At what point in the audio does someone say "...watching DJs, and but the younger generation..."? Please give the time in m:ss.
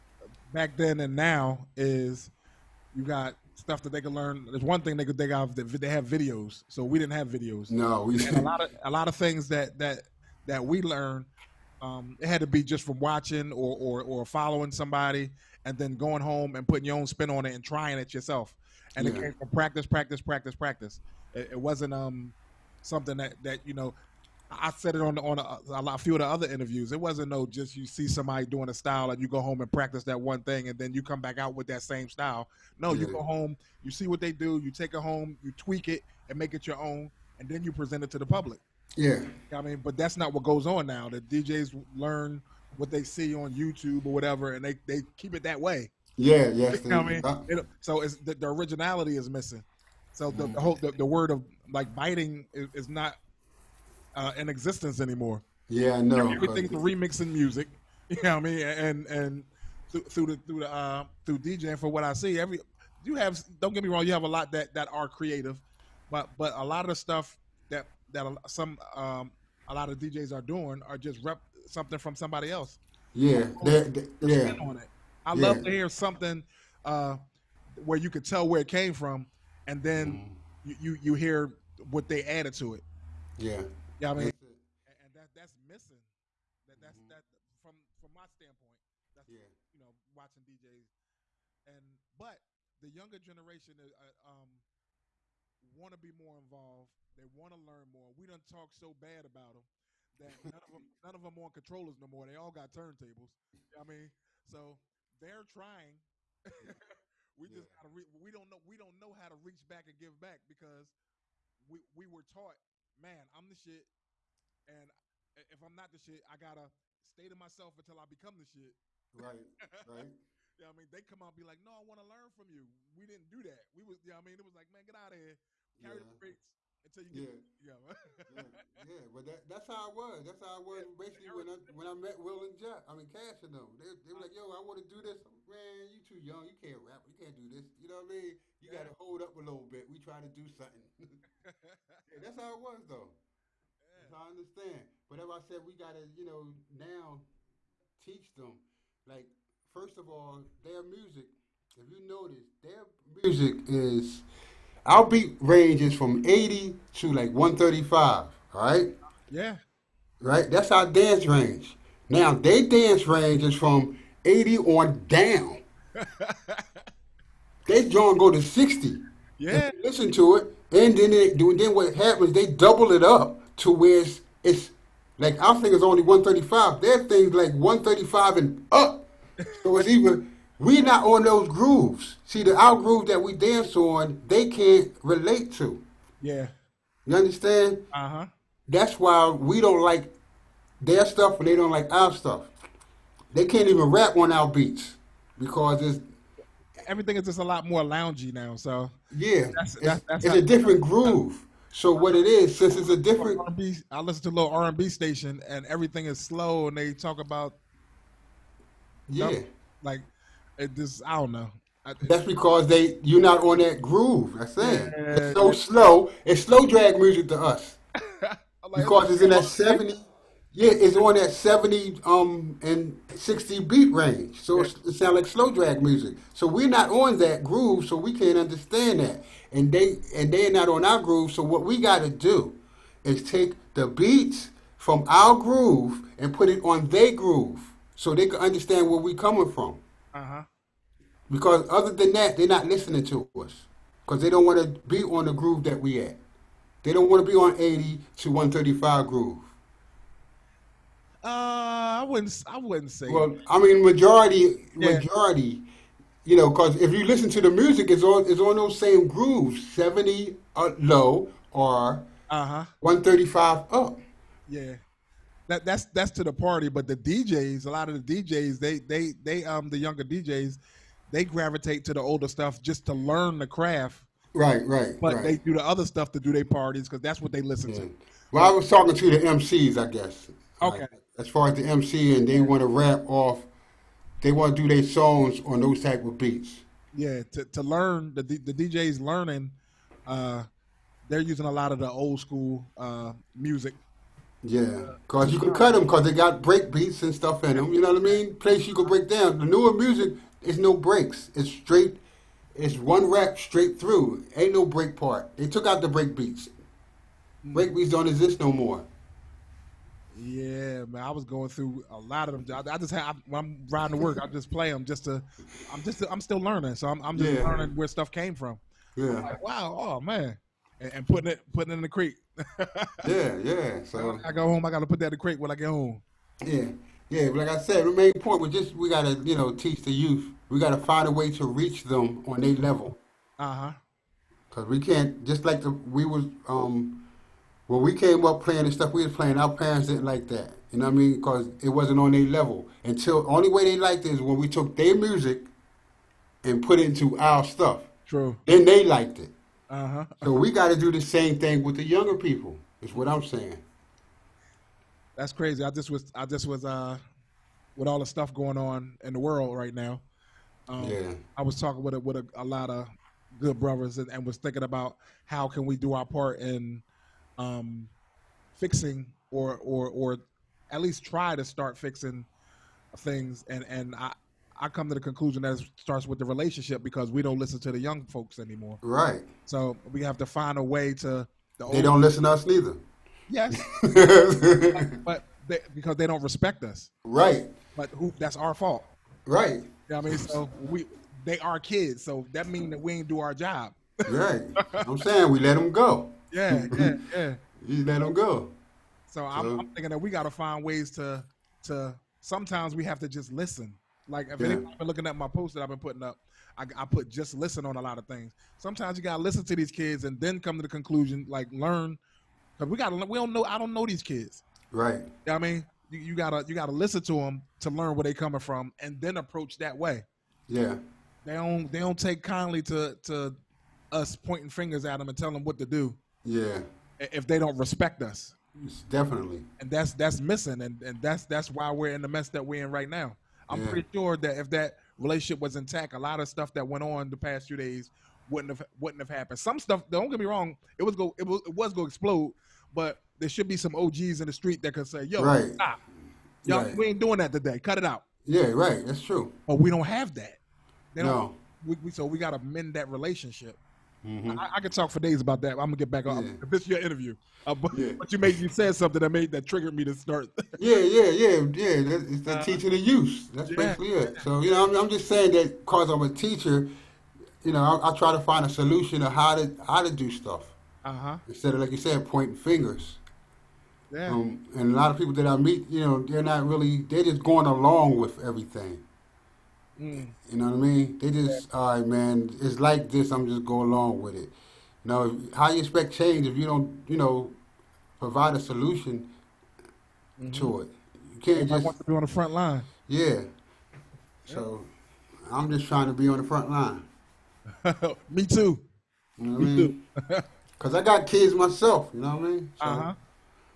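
1:30.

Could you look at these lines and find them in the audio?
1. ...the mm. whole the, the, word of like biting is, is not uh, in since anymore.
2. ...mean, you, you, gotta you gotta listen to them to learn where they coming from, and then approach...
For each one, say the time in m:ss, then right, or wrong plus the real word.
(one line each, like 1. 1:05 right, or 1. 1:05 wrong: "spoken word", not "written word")
1. 0:50 wrong: "existence", not "since"
2. 6:55 right.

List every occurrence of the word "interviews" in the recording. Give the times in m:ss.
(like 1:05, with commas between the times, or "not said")
0:26, 7:36.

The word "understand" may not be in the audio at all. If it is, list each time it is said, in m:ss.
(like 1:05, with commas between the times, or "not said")
2:24, 3:07, 3:48, 3:58.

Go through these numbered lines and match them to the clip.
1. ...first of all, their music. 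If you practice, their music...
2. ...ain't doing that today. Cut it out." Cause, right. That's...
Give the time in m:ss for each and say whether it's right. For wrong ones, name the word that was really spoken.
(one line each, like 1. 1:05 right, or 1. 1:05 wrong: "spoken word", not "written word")
1. 2:29 wrong: "notice", not "practice"
2. 7:26 wrong: "Yeah", not "Cause".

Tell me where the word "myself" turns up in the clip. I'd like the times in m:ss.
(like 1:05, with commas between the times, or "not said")
1:57, 8:21.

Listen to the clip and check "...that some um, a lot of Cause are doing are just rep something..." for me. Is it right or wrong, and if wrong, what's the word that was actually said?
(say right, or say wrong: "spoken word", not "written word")
wrong: "DJs", not "Cause".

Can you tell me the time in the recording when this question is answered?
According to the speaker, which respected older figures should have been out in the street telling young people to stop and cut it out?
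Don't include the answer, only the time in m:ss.
7:23.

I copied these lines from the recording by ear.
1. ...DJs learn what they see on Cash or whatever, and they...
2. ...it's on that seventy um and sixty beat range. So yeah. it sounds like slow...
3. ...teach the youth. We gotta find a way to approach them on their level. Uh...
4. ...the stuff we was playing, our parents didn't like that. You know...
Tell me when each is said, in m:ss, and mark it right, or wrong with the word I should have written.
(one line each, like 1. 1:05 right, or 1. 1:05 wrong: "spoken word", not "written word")
1. 0:41 wrong: "YouTube", not "Cash"
2. 3:40 right
3. 5:29 wrong: "reach", not "approach"
4. 5:38 right.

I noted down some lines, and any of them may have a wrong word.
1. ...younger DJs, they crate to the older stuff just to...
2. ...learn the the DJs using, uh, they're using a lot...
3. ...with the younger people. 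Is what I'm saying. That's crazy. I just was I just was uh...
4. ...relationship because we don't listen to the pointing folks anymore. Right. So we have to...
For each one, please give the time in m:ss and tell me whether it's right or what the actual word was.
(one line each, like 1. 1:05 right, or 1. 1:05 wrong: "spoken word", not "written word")
1. 4:29 wrong: "gravitate", not "crate"
2. 4:47 wrong: "learning", not "using"
3. 5:51 right
4. 6:16 wrong: "young", not "pointing".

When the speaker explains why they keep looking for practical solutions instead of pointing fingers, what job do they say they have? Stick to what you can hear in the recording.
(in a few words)
teacher.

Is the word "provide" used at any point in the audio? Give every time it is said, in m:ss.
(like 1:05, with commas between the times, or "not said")
8:07.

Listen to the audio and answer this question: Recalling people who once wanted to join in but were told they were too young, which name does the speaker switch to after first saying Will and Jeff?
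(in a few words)
Cash.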